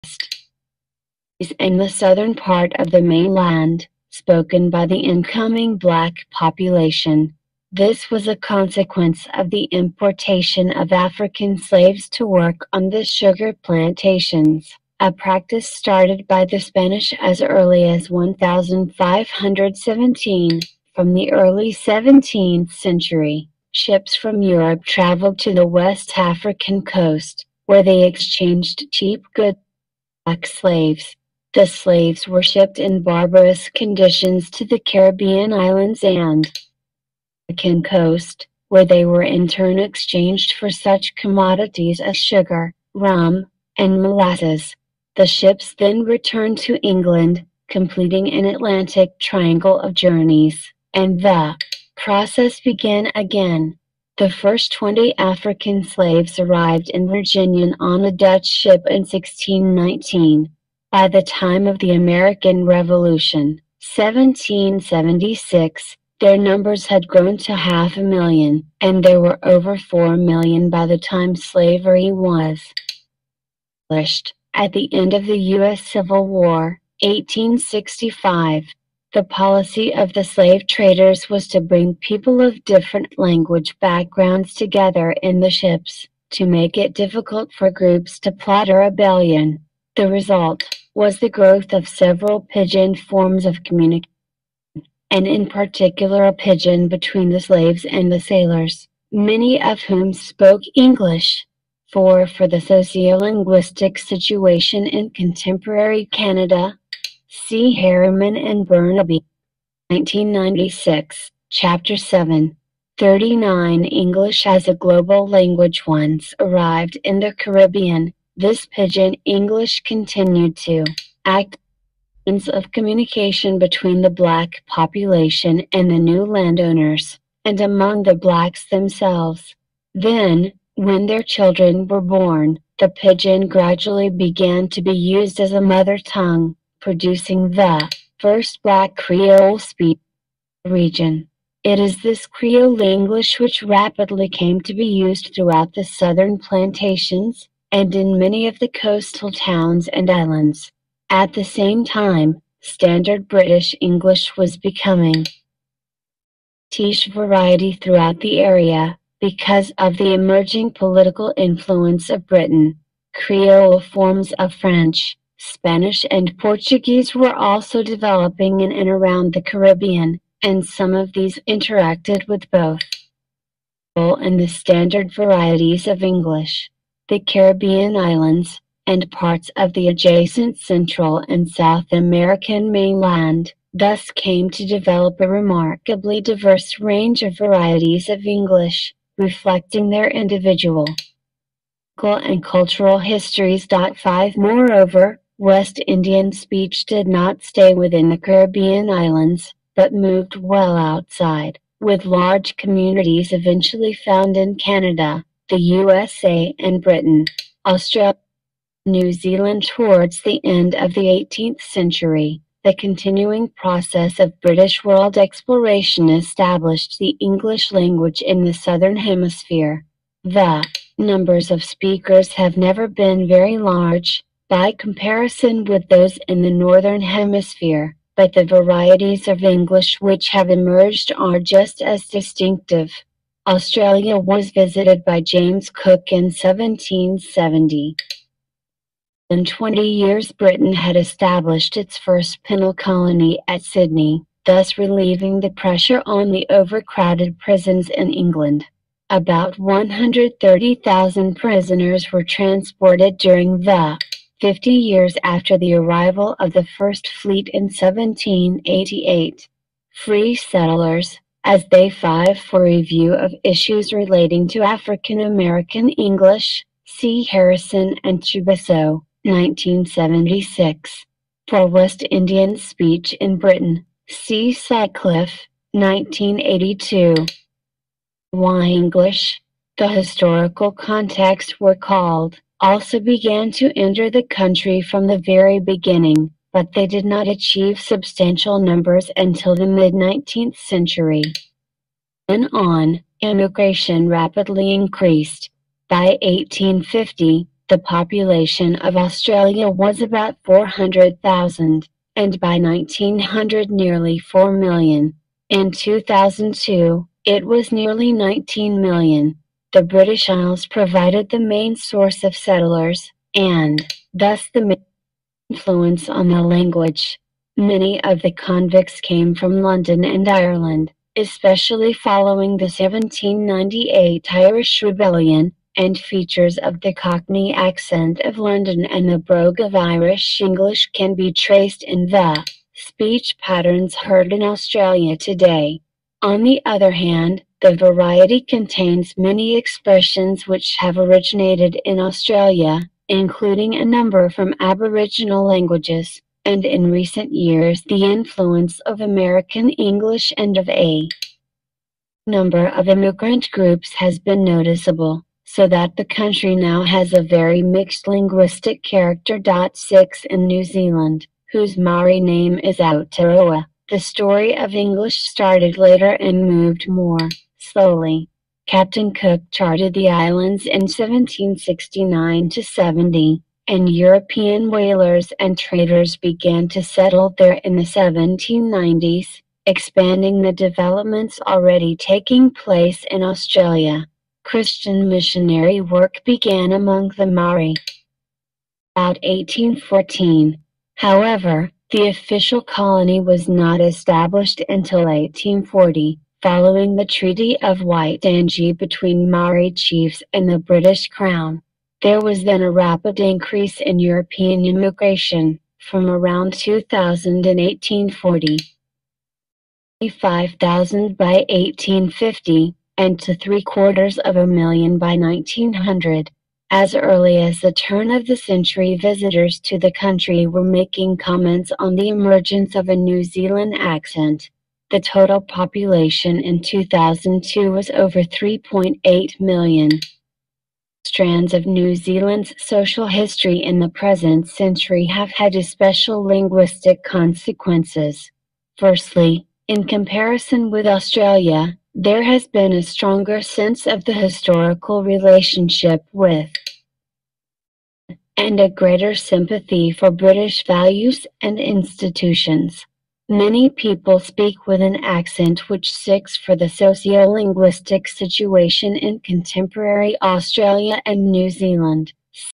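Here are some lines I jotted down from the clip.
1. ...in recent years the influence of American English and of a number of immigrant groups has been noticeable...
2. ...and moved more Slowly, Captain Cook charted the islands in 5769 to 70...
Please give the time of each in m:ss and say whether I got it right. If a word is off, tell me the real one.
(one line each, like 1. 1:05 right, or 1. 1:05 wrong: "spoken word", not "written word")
1. 5:46 right
2. 6:06 wrong: "1769", not "5769".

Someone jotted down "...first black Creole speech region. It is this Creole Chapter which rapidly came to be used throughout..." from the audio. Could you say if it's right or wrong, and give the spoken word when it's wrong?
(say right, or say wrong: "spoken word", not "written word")
wrong: "English", not "Chapter".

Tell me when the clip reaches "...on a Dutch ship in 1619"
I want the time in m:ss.
0:57.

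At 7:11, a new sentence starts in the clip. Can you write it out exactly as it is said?
Strands of New Zealand's social history in the present century have had especial linguistic consequences.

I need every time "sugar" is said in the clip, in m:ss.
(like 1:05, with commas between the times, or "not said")
0:13, 0:42.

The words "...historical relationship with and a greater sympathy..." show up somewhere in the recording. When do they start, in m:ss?
7:24.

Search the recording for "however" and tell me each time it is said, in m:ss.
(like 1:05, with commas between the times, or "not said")
6:30.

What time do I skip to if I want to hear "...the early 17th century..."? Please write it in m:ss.
0:21.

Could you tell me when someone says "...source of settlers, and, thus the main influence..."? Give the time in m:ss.
5:11.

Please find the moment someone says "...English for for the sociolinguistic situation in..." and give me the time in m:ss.
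1:40.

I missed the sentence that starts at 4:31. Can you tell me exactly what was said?
For West Indian Speech in Britain, see Sutcliffe, 1982.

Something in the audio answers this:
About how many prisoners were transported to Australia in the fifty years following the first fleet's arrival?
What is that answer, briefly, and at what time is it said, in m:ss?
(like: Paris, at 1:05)
130,000, at 4:09.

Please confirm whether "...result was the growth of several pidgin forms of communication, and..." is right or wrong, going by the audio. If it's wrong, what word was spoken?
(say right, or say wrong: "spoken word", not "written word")
right.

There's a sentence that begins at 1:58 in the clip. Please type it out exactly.
This pidgin English continued to act as of communication between the black population and the new landowners, and among the blacks themselves.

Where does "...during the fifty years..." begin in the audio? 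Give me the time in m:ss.
4:13.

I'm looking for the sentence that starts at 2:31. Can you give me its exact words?
At the same time, standard British English was becoming Tish variety throughout the area because of the emerging political influence of Britain.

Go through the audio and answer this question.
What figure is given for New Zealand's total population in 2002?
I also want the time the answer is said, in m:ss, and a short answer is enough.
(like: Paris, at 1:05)
over 3.8 million, at 7:07.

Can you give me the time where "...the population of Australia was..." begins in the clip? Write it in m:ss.
4:57.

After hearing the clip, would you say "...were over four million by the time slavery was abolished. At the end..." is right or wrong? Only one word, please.
right.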